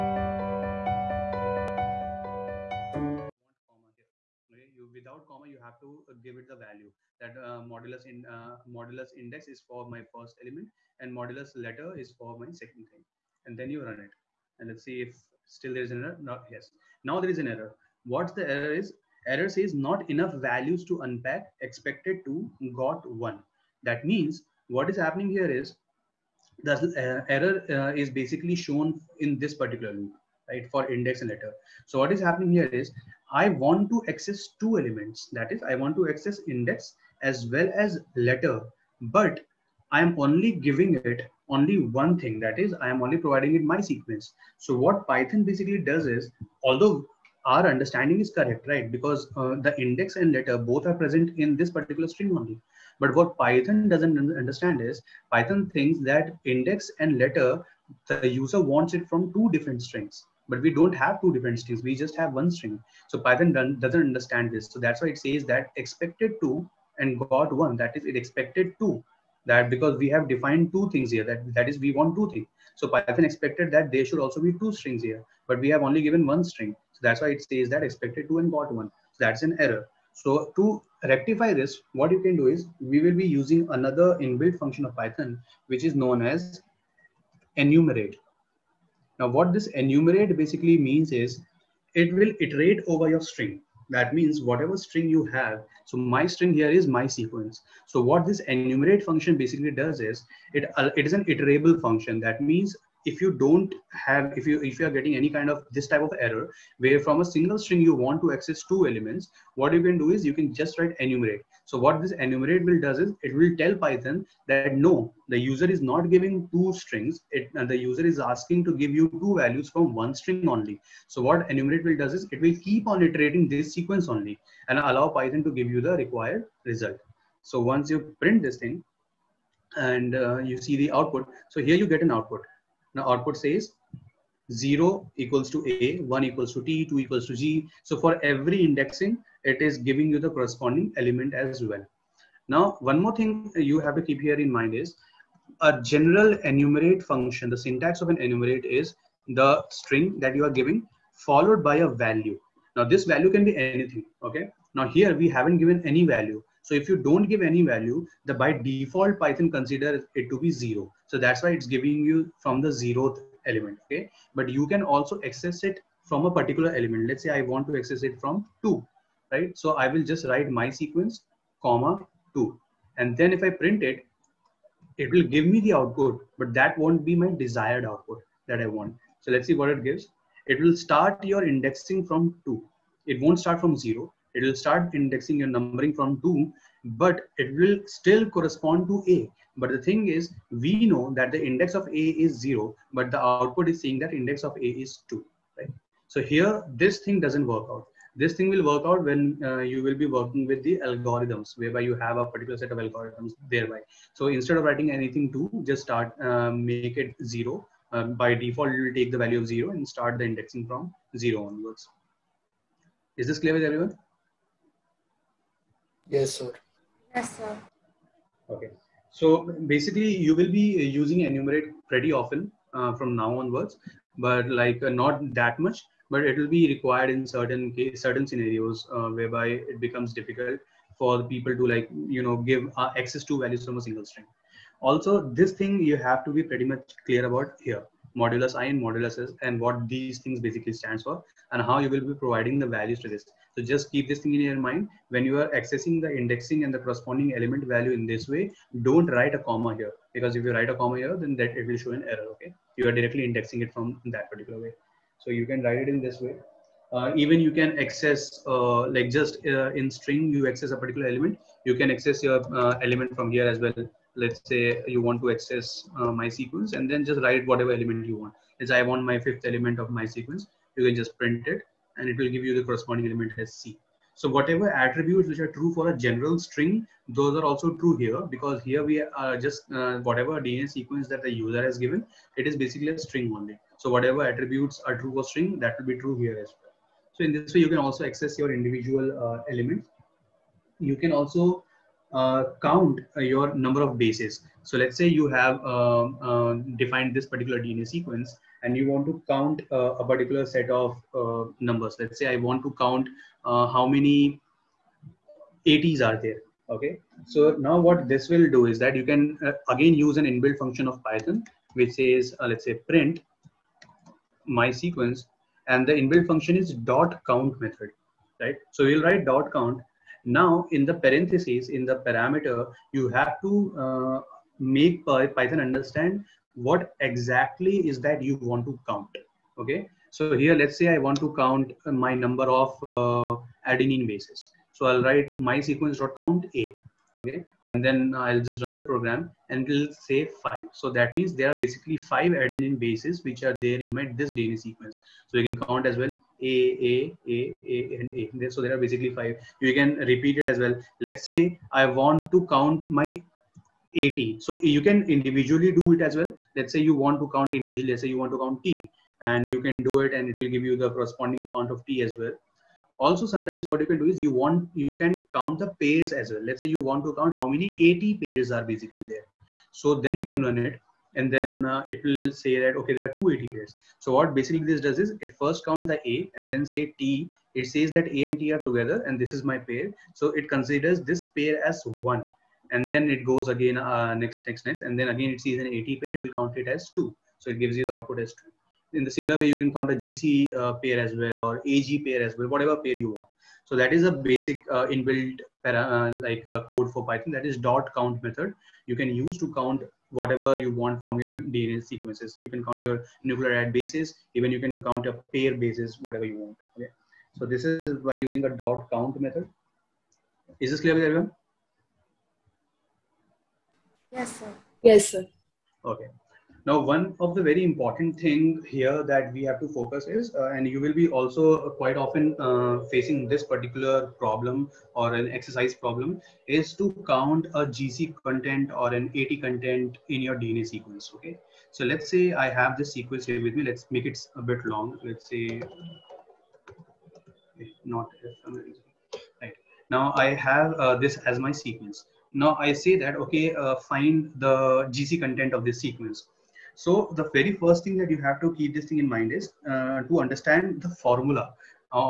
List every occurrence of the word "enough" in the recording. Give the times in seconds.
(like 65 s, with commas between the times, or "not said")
20 s.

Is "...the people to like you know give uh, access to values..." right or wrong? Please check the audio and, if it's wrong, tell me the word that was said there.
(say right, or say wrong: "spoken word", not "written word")
right.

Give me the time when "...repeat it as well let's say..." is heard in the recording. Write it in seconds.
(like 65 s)
350 s.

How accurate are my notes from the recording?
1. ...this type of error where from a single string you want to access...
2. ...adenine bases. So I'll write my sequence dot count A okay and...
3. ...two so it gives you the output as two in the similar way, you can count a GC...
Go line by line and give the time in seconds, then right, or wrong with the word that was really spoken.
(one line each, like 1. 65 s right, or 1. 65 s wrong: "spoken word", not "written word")
1. 105 s right
2. 333 s right
3. 387 s right.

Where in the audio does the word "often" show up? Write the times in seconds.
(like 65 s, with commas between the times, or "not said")
222 s, 421 s.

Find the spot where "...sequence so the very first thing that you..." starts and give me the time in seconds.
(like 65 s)
445 s.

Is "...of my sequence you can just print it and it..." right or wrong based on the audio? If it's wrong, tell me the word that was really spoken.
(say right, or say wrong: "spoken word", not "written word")
right.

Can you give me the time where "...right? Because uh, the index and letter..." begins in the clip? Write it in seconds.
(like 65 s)
48 s.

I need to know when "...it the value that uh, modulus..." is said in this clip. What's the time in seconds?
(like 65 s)
6 s.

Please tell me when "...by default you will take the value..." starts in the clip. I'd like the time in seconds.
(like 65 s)
208 s.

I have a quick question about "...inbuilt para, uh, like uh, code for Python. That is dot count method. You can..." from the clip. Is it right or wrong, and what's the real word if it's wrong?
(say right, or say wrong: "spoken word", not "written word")
right.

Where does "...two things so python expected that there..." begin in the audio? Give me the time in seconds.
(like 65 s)
72 s.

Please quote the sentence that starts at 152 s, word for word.
Now, this value can be anything.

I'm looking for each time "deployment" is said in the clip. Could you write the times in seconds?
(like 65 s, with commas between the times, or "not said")
not said.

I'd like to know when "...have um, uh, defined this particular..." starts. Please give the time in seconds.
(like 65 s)
295 s.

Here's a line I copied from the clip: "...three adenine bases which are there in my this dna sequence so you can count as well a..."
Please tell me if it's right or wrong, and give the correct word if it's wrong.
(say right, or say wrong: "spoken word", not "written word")
wrong: "five", not "three".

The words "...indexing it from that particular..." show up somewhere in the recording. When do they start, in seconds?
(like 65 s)
253 s.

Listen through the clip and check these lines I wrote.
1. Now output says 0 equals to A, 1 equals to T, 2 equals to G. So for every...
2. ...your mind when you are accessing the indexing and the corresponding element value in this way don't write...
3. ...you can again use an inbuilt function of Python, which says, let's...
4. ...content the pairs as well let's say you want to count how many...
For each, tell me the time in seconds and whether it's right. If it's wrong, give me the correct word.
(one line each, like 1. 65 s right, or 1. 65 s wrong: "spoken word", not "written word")
1. 132 s right
2. 244 s right
3. 308 s right
4. 365 s wrong: "count", not "content".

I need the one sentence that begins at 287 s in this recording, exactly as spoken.
So in this way, you can also access your individual uh, elements.